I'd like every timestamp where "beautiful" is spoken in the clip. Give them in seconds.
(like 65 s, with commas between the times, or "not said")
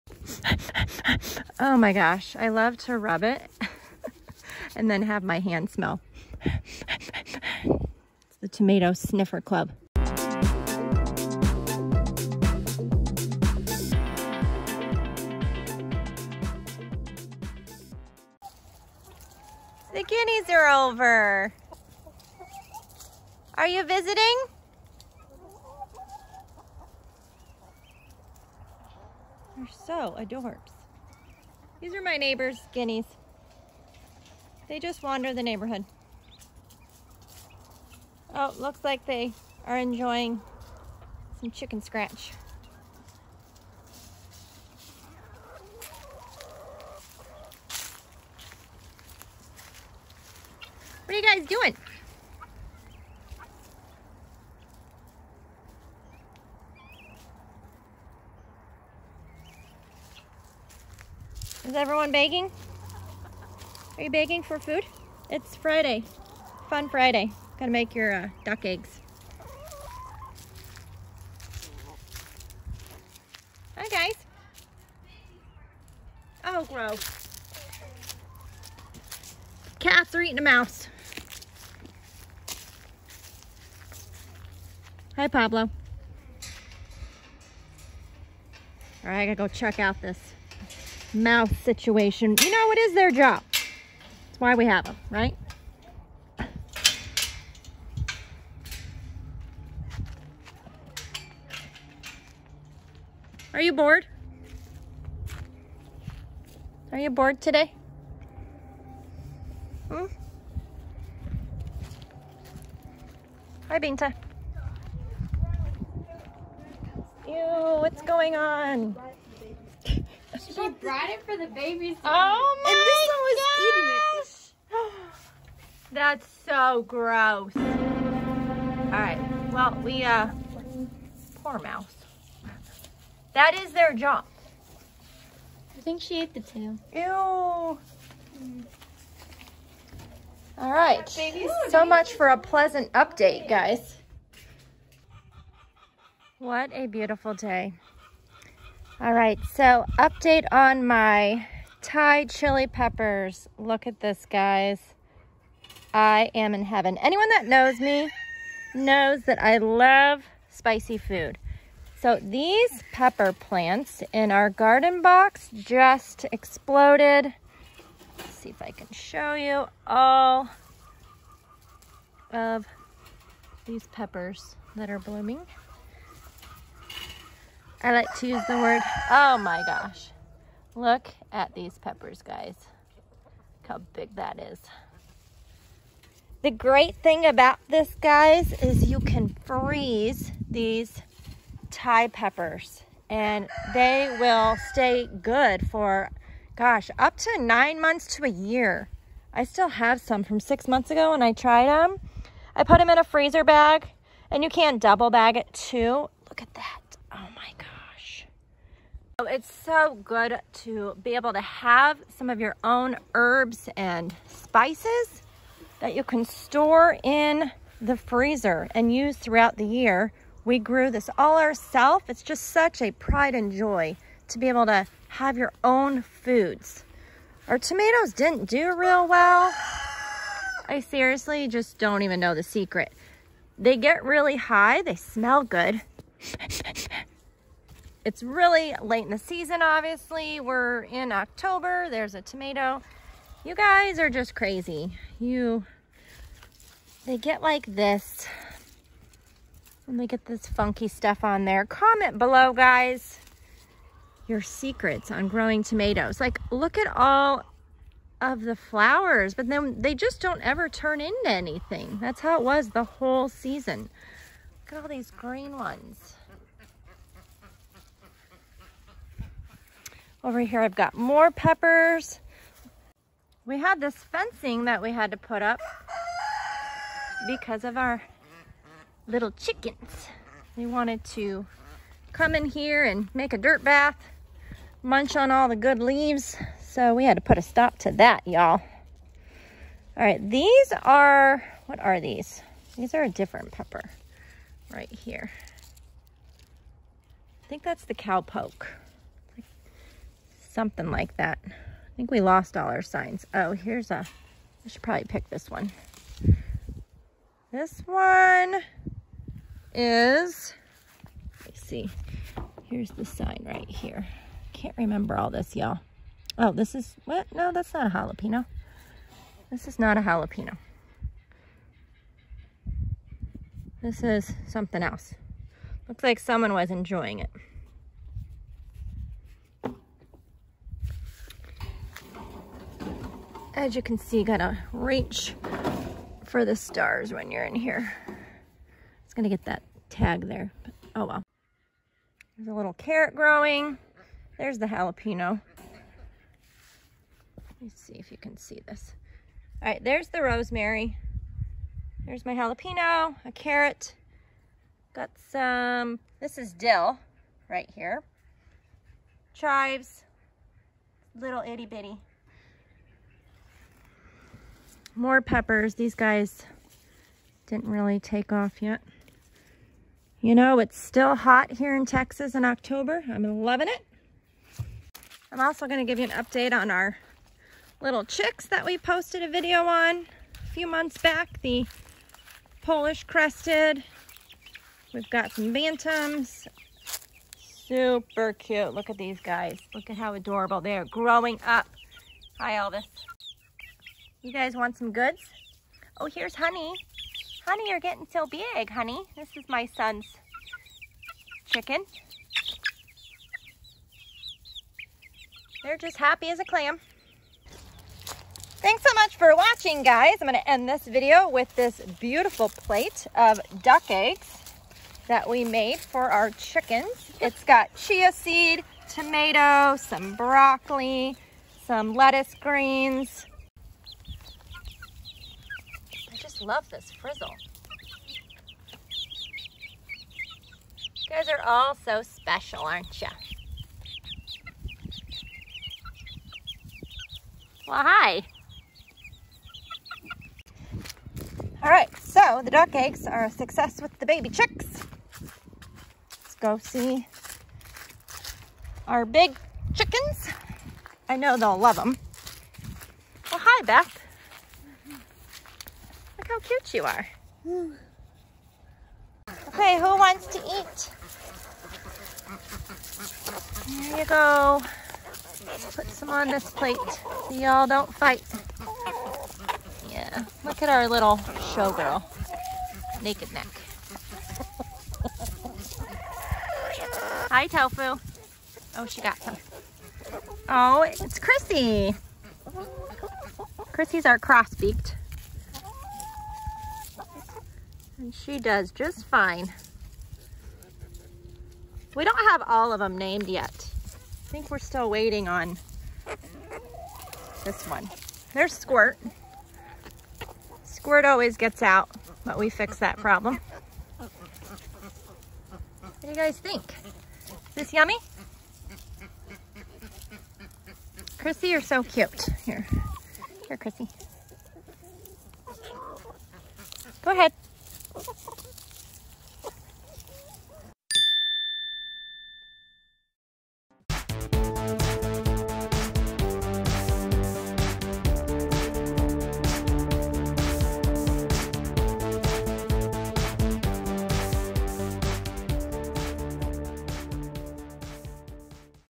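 146 s, 411 s.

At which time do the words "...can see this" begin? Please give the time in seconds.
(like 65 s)
348 s.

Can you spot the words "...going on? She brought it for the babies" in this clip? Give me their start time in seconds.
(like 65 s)
118 s.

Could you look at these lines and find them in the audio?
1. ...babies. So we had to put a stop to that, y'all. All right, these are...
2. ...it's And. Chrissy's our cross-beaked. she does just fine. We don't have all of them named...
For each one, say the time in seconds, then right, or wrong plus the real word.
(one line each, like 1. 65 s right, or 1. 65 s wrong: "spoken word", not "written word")
1. 285 s wrong: "leaves", not "babies"
2. 480 s wrong: "Chrissy", not "And".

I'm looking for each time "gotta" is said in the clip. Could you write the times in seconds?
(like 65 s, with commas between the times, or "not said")
67 s, 89 s, 334 s.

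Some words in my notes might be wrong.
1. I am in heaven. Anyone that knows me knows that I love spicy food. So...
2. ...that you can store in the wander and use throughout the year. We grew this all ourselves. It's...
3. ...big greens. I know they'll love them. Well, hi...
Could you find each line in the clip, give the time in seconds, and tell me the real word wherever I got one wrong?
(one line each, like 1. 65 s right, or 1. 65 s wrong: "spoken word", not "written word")
1. 155 s right
2. 215 s wrong: "freezer", not "wander"
3. 449 s wrong: "chickens", not "greens".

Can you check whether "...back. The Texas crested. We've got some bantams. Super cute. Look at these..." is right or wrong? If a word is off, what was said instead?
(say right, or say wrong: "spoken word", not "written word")
wrong: "Polish", not "Texas".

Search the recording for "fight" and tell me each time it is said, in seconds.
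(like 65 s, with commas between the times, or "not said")
467 s.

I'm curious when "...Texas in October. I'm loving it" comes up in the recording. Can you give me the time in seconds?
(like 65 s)
371 s.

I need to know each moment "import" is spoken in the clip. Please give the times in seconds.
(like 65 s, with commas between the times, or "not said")
not said.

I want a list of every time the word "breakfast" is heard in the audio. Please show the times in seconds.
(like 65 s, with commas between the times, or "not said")
not said.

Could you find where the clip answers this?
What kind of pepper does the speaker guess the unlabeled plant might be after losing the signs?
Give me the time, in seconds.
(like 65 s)
297 s.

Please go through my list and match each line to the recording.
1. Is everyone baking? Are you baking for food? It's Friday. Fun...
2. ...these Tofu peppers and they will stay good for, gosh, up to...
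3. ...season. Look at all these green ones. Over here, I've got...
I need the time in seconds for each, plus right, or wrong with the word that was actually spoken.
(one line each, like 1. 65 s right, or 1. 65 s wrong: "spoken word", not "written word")
1. 61 s right
2. 190 s wrong: "Thai", not "Tofu"
3. 263 s right.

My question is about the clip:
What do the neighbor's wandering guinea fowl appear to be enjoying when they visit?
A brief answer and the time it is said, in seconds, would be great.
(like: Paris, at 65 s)
Chicken scratch, at 41 s.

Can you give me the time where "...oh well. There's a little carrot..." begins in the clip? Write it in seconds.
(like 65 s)
340 s.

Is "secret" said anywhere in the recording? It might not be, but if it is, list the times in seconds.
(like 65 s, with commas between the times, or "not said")
232 s, 254 s.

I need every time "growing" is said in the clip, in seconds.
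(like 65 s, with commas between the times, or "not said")
255 s, 343 s, 390 s.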